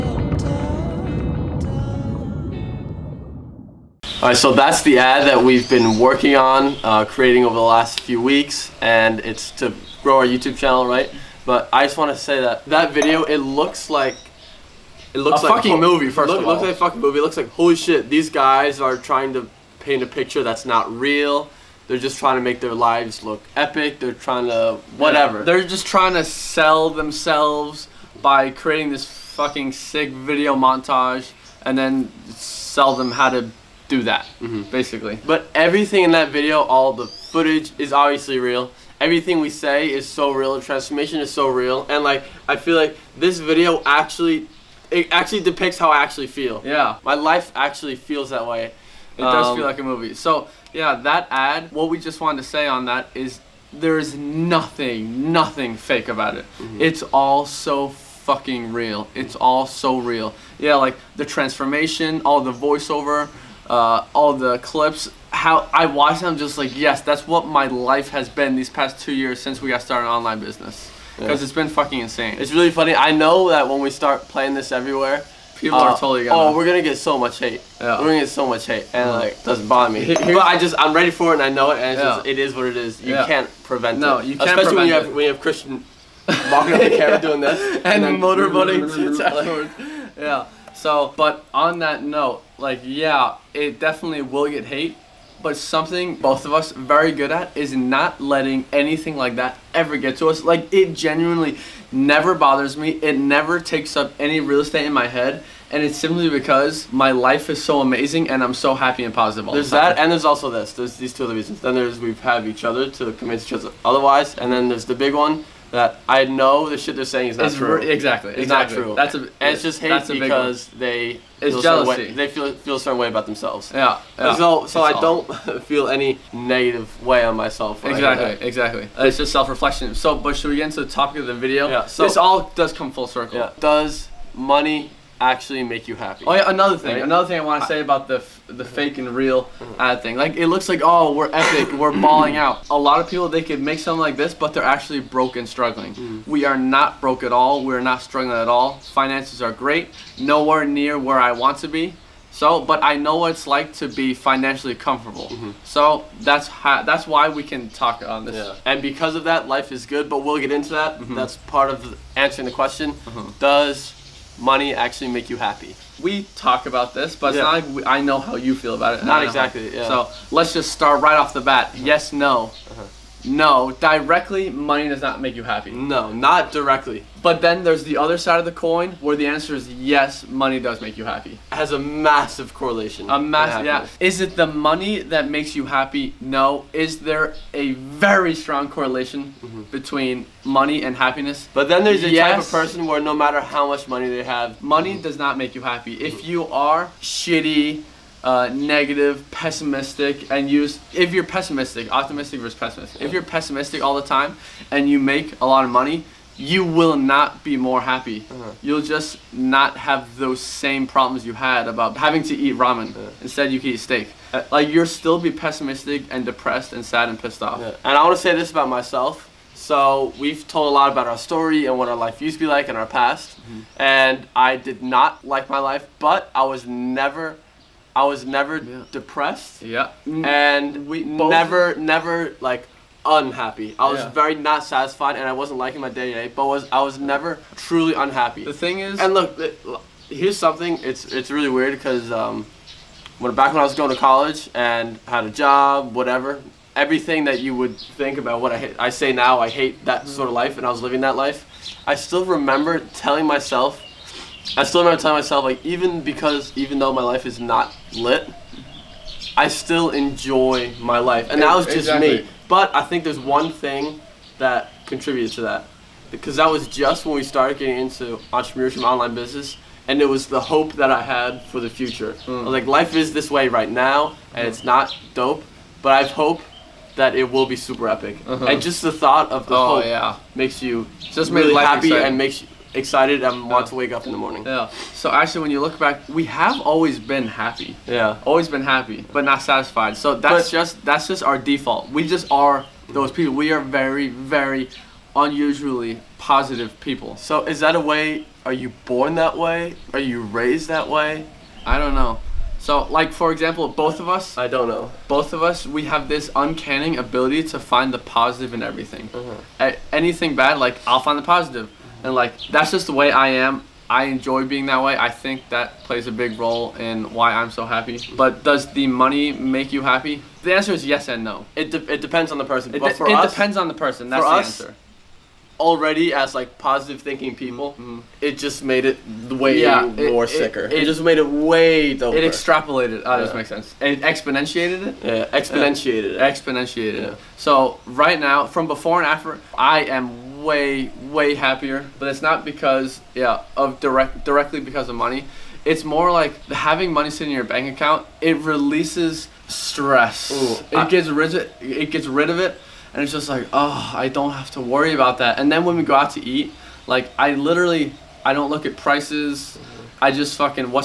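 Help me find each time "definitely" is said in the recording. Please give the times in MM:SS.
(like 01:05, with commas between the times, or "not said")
01:33.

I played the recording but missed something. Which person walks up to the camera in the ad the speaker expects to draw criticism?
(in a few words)
Christian.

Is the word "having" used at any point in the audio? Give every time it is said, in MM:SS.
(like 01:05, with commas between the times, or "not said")
03:31, 05:46.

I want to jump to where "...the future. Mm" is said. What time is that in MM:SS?
04:31.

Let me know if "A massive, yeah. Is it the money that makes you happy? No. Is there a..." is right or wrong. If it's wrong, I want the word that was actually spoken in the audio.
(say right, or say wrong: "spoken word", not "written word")
right.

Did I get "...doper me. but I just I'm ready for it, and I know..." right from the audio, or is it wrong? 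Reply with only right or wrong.
wrong.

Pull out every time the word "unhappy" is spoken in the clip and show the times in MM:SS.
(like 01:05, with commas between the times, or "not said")
03:53, 03:57.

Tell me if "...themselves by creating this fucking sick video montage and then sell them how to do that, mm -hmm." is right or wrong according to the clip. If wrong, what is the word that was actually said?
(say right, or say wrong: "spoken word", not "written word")
right.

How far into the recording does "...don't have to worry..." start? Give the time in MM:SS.
05:54.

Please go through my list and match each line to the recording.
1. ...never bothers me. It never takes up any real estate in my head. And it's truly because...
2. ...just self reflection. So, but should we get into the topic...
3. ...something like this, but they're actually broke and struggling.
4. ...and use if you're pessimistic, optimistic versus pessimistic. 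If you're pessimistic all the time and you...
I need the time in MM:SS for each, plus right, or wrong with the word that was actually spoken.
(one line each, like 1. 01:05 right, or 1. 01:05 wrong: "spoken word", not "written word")
1. 01:41 wrong: "simply", not "truly"
2. 02:09 right
3. 02:23 right
4. 03:20 right.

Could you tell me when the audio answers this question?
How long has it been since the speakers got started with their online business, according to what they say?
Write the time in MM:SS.
01:08.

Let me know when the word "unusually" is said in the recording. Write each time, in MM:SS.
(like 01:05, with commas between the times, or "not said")
04:55.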